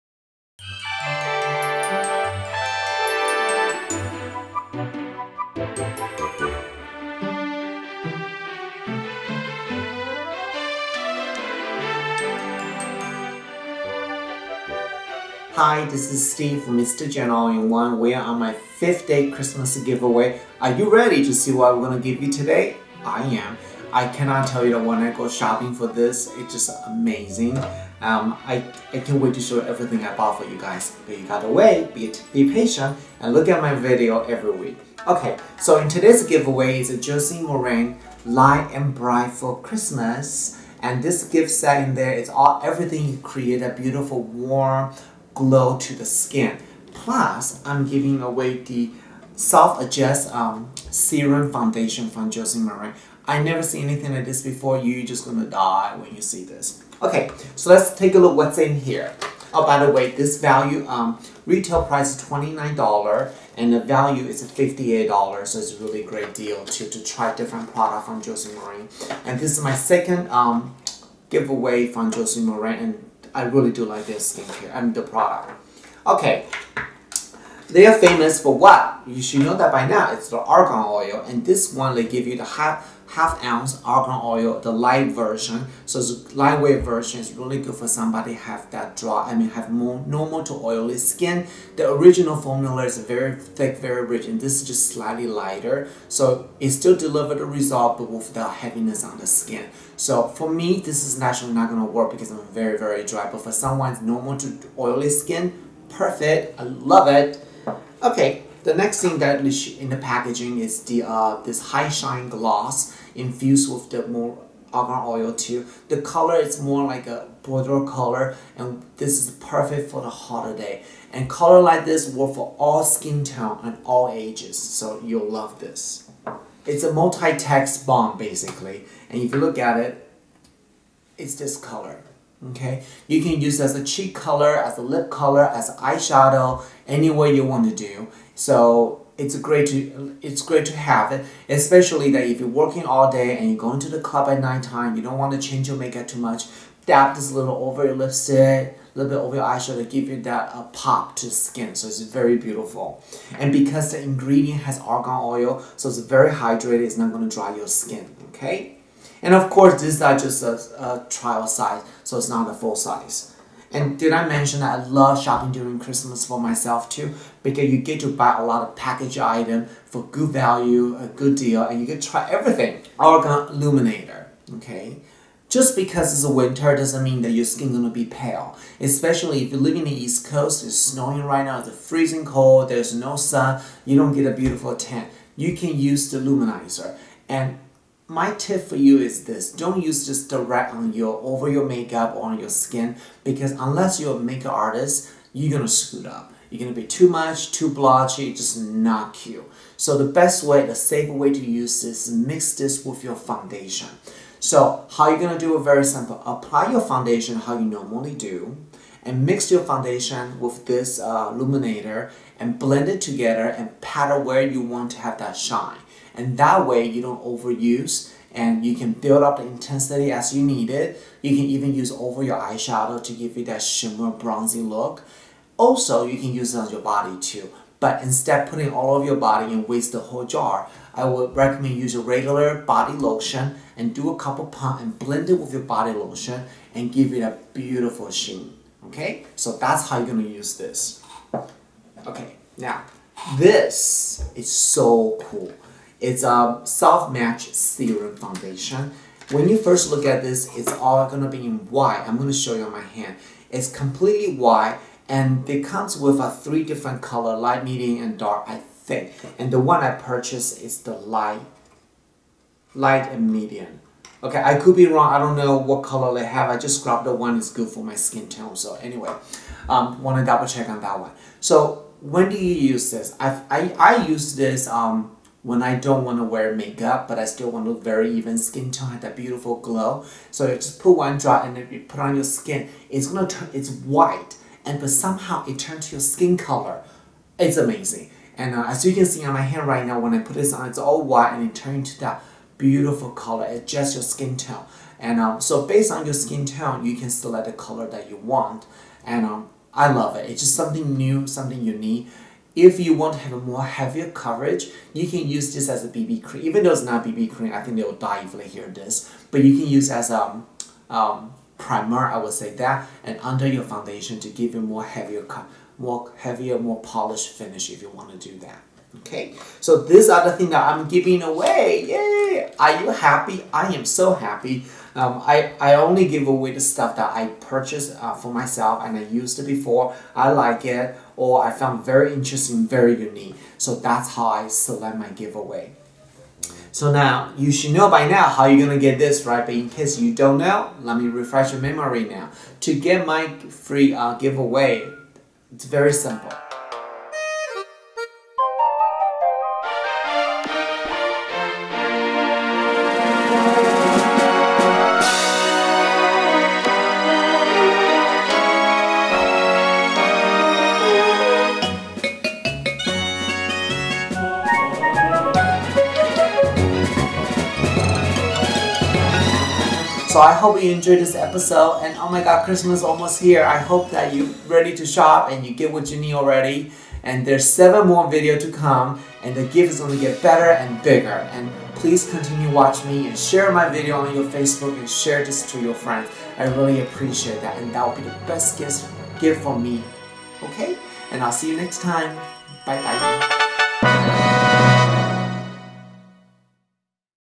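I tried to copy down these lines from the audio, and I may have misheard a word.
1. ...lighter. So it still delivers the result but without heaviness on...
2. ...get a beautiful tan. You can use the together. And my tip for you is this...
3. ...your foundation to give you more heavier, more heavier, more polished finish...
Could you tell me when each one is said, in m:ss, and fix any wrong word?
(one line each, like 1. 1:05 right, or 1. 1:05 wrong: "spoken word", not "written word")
1. 1:35 right
2. 3:04 wrong: "luminizer", not "together"
3. 5:13 right.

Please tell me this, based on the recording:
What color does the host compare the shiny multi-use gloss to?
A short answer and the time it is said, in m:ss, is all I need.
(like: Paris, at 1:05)
bordeaux, at 1:57.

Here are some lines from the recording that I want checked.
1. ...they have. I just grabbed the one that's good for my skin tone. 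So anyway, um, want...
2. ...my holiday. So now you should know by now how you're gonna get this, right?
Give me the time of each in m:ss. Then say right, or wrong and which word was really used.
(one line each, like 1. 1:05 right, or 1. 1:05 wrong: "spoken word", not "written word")
1. 4:26 right
2. 5:34 wrong: "giveaway", not "holiday".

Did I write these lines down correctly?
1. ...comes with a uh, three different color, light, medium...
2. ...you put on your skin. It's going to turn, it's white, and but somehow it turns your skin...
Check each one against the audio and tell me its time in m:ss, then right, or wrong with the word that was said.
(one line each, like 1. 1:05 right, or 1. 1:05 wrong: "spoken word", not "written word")
1. 4:15 right
2. 4:41 right.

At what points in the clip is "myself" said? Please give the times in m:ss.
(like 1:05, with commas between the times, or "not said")
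2:46, 5:28.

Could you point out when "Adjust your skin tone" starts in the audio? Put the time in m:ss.
4:53.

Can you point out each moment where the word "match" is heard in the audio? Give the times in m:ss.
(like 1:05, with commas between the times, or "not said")
4:06.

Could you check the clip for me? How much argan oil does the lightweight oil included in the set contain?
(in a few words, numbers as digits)
half ounce.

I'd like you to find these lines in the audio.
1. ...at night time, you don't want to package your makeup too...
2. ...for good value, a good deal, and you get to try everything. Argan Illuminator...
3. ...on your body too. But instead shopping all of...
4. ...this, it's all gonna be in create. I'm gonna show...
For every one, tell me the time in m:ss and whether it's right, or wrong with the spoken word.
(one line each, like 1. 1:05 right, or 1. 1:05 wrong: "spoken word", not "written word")
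1. 2:24 wrong: "change", not "package"
2. 2:49 right
3. 3:46 wrong: "putting", not "shopping"
4. 4:10 wrong: "white", not "create".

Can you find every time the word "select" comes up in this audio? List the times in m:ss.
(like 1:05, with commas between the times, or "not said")
4:57, 5:34.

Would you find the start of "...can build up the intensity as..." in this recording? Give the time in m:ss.
3:38.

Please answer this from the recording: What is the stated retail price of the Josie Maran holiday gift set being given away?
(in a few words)
$29.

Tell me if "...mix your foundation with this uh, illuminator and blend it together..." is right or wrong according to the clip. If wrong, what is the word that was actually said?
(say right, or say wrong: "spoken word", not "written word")
right.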